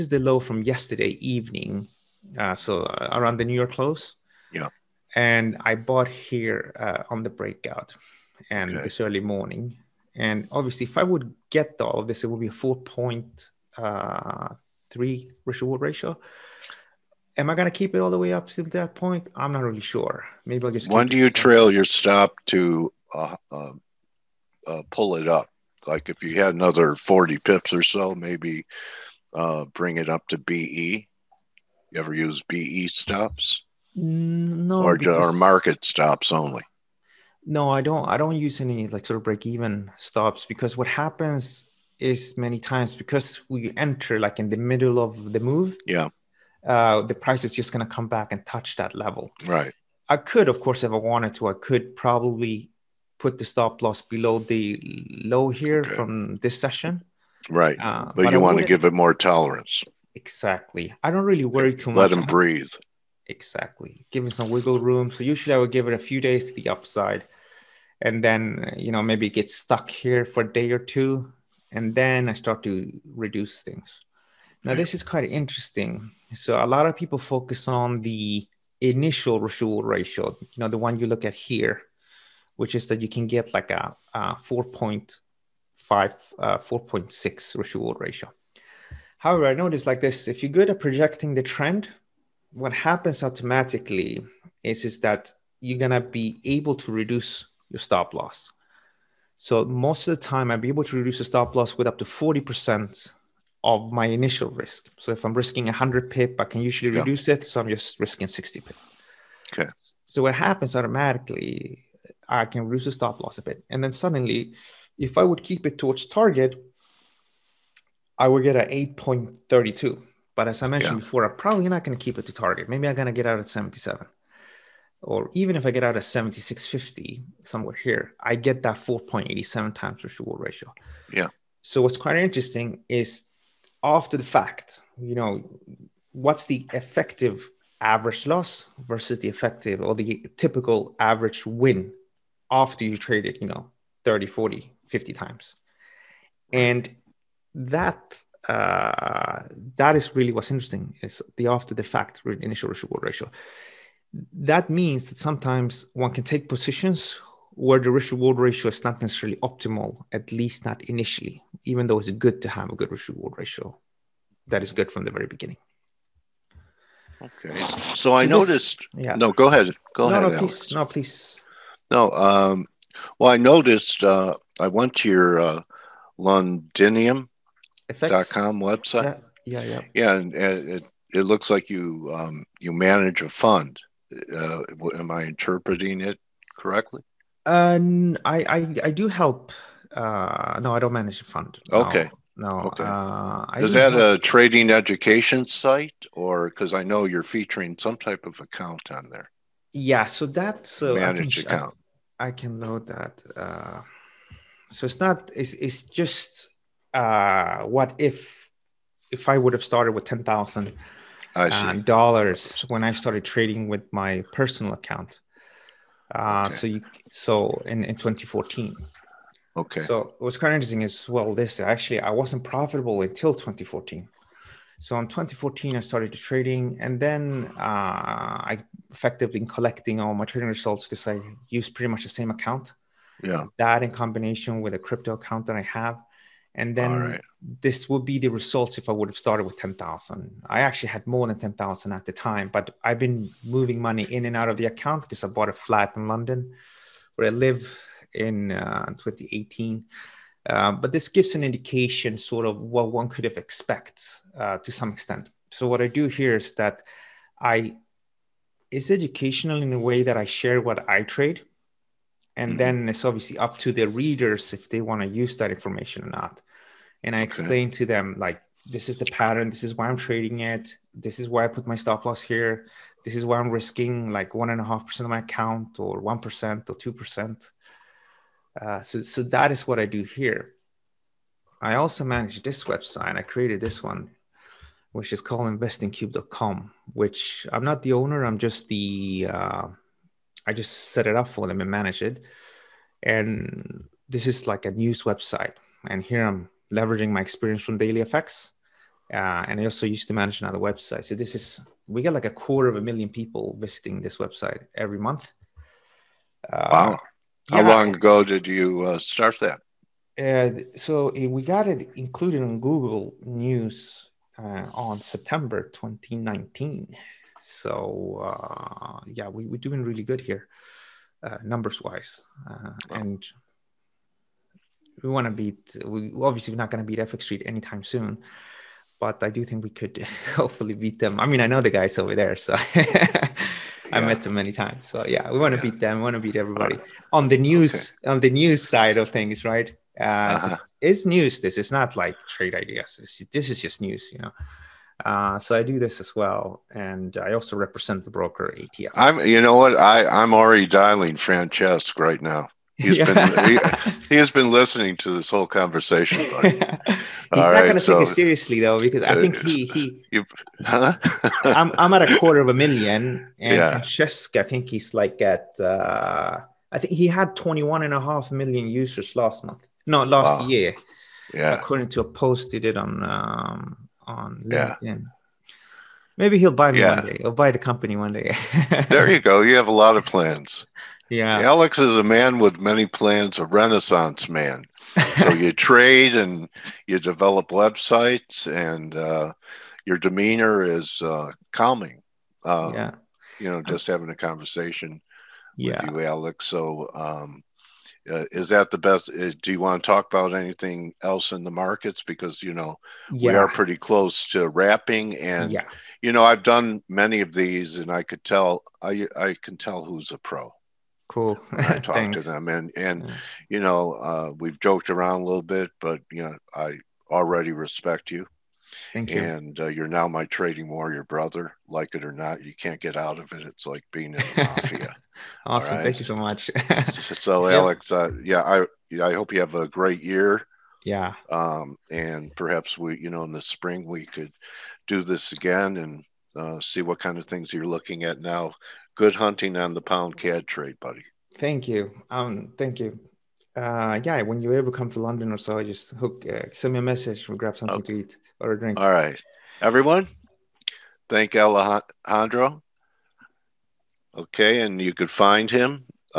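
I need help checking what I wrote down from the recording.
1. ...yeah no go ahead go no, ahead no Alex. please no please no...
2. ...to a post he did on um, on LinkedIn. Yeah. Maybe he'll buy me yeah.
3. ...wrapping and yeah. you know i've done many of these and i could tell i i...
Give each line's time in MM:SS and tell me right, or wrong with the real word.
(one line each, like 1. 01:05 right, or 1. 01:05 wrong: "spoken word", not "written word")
1. 02:49 right
2. 06:11 right
3. 06:44 right.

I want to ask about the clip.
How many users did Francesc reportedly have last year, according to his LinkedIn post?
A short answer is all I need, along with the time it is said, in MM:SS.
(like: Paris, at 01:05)
21.5 million, at 06:07.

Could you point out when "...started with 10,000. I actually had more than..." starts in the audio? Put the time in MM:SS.
03:59.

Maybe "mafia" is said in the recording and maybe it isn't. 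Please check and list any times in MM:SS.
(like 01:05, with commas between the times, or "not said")
07:04.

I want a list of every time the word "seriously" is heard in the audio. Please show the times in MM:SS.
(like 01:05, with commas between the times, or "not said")
05:58.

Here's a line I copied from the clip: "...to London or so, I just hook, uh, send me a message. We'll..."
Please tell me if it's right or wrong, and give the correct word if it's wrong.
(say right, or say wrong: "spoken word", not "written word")
right.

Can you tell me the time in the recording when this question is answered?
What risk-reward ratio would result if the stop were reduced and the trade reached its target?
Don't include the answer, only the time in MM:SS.
01:58.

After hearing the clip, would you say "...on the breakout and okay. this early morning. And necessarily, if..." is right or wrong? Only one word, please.
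wrong.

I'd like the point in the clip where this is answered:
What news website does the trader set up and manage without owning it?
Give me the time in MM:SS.
04:45.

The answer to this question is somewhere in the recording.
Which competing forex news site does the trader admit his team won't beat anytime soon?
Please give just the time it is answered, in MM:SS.
05:26.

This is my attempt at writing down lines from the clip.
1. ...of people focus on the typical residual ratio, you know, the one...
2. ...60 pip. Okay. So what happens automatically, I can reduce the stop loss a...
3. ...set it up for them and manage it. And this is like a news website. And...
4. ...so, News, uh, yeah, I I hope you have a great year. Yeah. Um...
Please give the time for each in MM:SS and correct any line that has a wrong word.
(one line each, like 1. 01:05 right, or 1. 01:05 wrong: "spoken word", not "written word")
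1. 01:16 wrong: "initial", not "typical"
2. 01:48 right
3. 04:50 right
4. 07:06 wrong: "Alex", not "News".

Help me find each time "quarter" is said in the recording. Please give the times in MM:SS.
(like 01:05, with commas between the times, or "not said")
05:02, 06:02.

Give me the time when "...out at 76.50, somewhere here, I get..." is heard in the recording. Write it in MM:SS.
02:05.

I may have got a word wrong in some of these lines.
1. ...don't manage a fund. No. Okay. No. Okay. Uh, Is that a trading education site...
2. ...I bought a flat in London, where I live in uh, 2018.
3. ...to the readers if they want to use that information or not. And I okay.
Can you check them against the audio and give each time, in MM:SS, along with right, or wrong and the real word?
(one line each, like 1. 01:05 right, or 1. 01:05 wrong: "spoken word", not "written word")
1. 03:10 right
2. 04:05 right
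3. 04:23 right.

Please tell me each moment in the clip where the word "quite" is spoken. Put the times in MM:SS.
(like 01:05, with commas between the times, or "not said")
01:15, 02:11.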